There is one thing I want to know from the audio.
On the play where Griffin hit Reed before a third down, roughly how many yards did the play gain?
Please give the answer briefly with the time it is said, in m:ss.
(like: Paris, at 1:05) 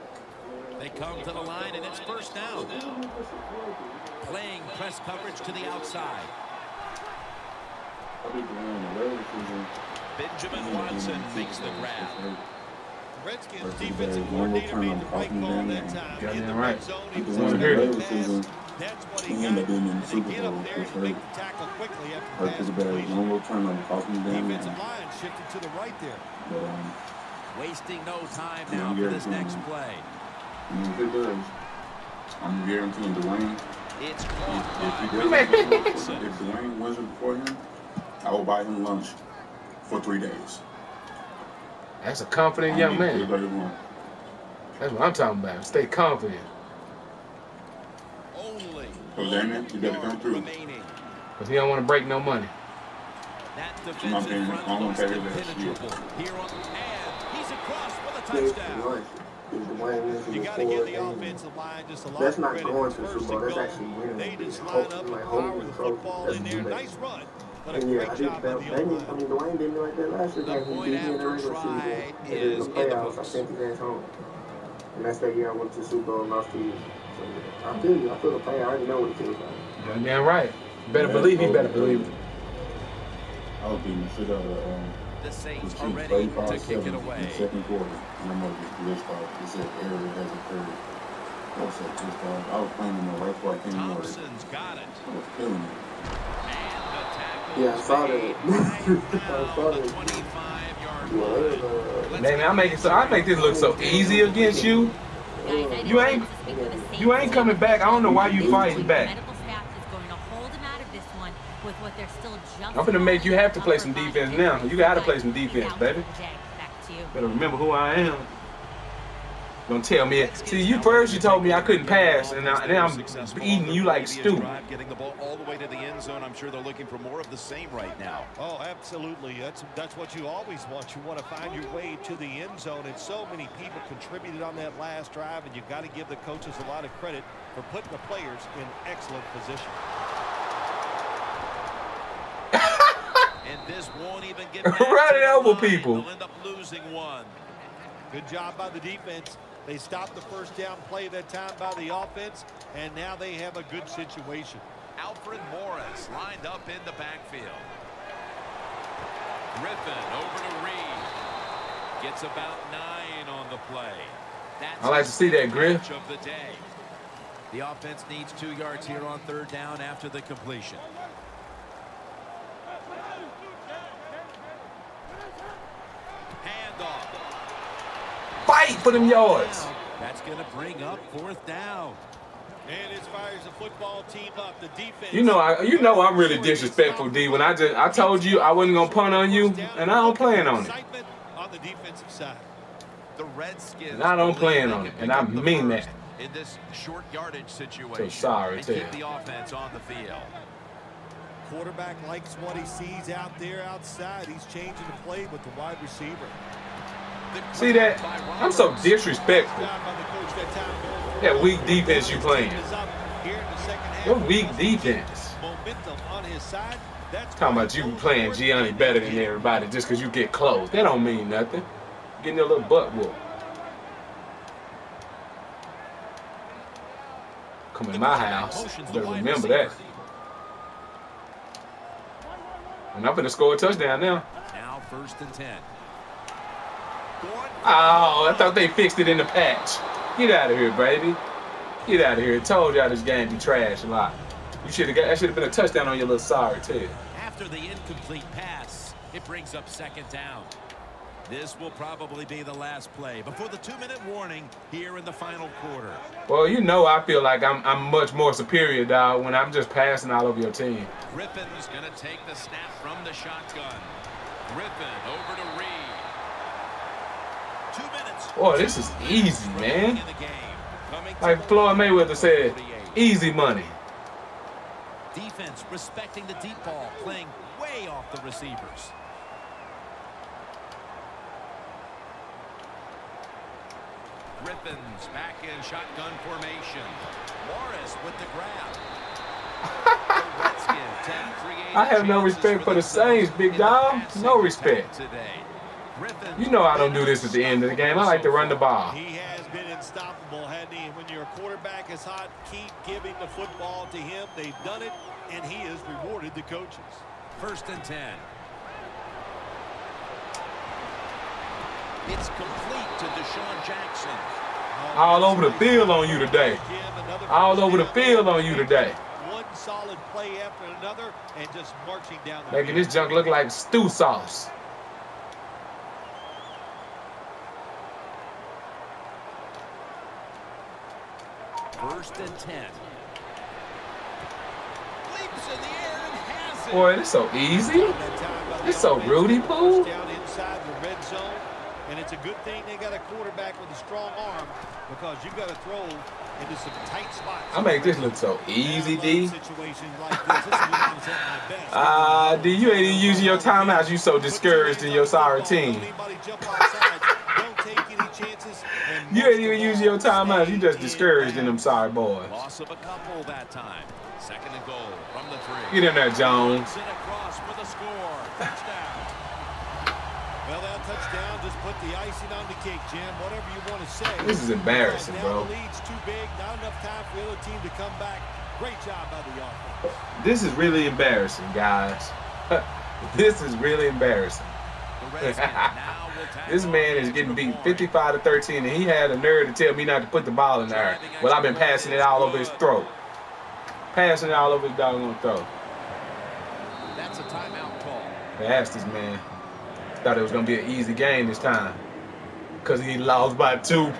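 9, at 2:42.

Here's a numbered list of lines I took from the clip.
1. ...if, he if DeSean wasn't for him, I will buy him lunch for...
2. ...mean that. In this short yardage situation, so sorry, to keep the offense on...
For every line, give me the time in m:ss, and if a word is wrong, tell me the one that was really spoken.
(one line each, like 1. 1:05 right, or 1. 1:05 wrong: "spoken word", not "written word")
1. 0:34 wrong: "Dwayne", not "DeSean"
2. 3:15 right.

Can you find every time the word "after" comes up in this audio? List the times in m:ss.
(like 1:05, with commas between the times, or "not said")
1:10, 2:49, 4:07, 5:20.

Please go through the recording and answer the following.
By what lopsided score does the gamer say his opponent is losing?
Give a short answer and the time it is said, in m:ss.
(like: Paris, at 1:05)
55 to 13, at 6:27.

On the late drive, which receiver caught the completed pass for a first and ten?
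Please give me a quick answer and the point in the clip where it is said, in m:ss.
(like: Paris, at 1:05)
DeSean Jackson, at 5:13.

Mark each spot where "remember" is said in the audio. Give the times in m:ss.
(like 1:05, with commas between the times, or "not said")
1:57, 3:49.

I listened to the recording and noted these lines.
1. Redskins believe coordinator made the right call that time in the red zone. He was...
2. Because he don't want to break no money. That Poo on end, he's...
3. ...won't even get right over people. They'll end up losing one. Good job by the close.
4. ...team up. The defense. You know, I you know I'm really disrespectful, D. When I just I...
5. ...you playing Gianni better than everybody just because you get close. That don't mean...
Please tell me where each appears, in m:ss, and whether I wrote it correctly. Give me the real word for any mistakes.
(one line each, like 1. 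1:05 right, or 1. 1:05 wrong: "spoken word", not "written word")
1. 0:13 wrong: "defensive", not "believe"
2. 0:50 wrong: "Here", not "Poo"
3. 2:23 wrong: "defense", not "close"
4. 3:04 right
5. 3:37 right.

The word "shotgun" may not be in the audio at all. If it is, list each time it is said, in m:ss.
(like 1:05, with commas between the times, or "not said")
4:23, 4:45.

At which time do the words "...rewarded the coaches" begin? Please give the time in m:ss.
5:05.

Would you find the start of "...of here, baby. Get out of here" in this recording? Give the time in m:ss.
4:00.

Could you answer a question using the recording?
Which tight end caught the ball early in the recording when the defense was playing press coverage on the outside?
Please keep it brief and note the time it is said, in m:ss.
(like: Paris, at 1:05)
Benjamin Watson, at 0:10.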